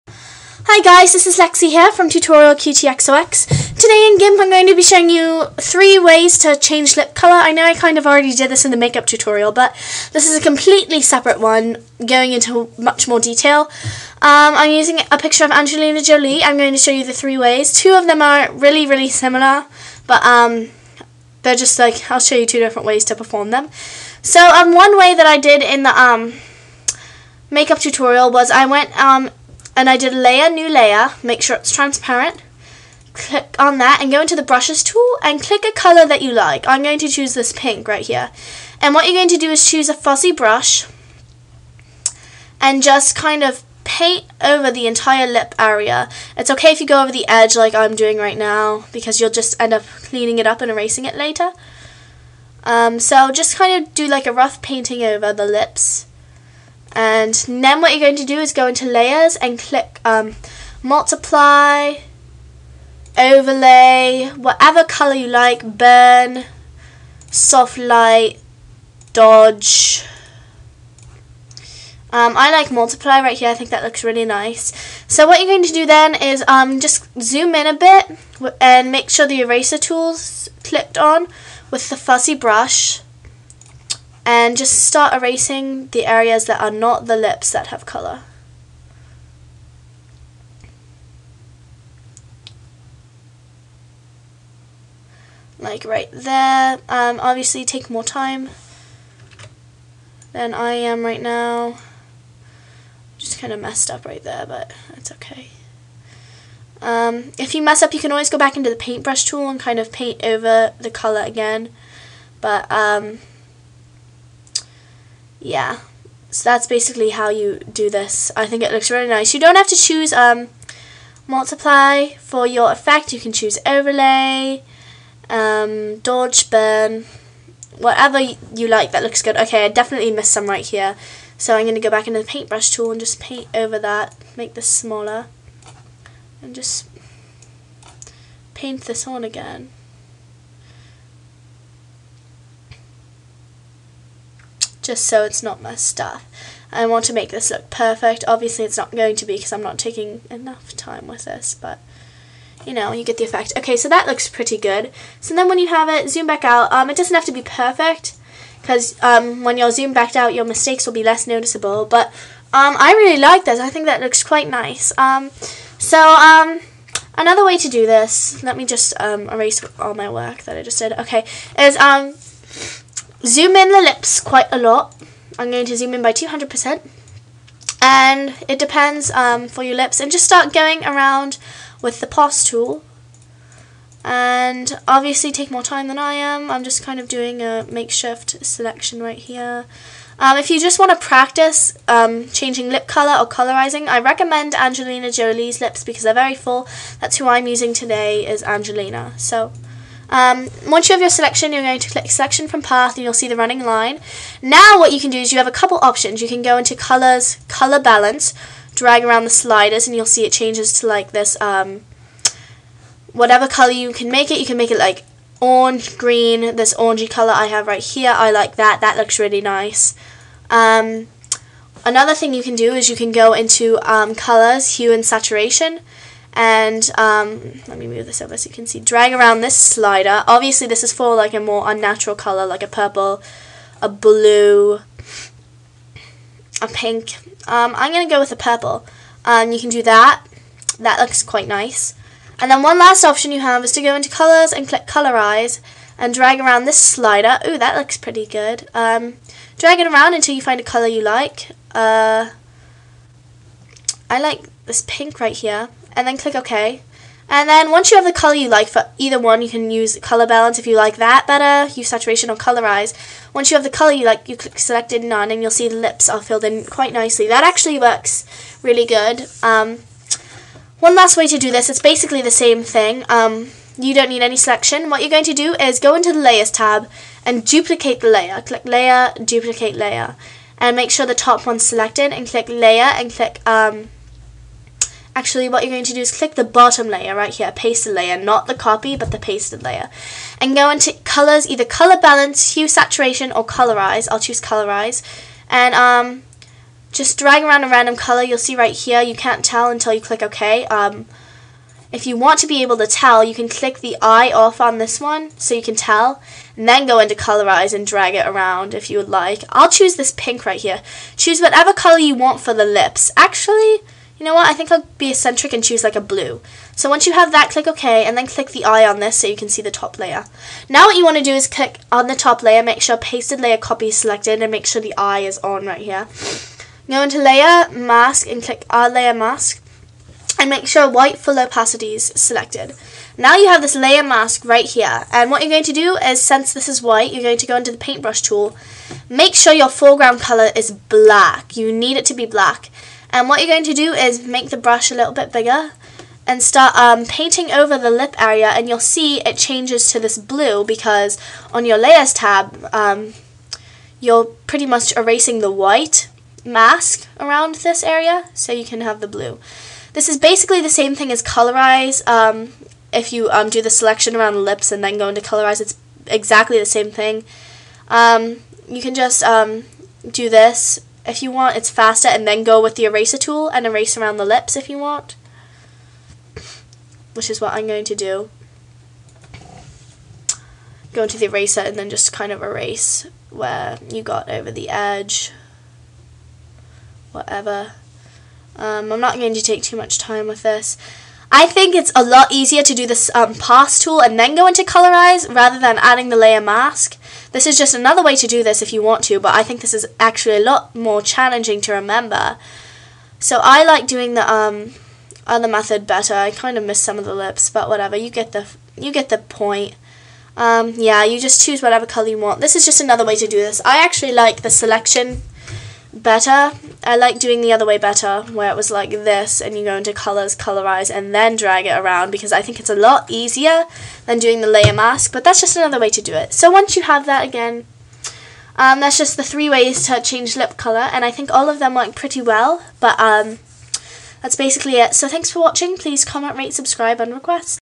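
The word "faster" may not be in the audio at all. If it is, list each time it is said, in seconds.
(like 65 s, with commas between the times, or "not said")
371 s.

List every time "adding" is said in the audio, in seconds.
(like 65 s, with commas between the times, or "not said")
395 s.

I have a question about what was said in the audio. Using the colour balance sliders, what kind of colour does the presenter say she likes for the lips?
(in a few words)
Orangey.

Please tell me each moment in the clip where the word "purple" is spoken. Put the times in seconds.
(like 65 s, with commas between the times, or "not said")
232 s, 238 s.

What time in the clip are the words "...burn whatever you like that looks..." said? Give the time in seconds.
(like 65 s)
126 s.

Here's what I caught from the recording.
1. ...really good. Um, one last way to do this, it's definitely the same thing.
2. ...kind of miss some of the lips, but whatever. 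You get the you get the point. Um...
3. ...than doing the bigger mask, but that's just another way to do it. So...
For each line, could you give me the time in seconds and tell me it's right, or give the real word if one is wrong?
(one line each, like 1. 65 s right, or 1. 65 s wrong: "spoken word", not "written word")
1. 268 s wrong: "basically", not "definitely"
2. 406 s right
3. 424 s wrong: "layer", not "bigger".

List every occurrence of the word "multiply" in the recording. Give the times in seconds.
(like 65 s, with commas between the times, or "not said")
60 s, 72 s, 121 s.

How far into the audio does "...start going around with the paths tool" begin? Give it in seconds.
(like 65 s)
180 s.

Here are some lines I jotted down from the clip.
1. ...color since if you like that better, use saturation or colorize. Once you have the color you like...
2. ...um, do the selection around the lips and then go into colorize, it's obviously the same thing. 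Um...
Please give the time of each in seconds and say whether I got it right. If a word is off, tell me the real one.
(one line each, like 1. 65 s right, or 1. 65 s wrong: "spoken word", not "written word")
1. 260 s wrong: "balance", not "since"
2. 363 s wrong: "exactly", not "obviously".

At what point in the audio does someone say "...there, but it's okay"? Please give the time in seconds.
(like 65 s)
104 s.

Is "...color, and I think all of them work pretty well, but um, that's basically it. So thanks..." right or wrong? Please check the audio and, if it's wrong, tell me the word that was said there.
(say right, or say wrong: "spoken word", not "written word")
right.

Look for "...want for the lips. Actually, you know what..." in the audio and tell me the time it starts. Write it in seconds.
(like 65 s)
312 s.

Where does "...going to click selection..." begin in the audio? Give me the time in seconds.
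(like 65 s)
201 s.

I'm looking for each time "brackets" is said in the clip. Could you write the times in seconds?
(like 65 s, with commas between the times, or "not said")
not said.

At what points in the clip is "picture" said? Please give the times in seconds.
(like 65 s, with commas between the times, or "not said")
15 s.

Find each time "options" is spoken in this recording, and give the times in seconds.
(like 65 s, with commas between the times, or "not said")
205 s, 243 s.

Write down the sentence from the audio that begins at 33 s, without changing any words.
Click on that and go into the brushes tool and click a color that you like.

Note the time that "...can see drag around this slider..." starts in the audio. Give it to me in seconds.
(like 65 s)
228 s.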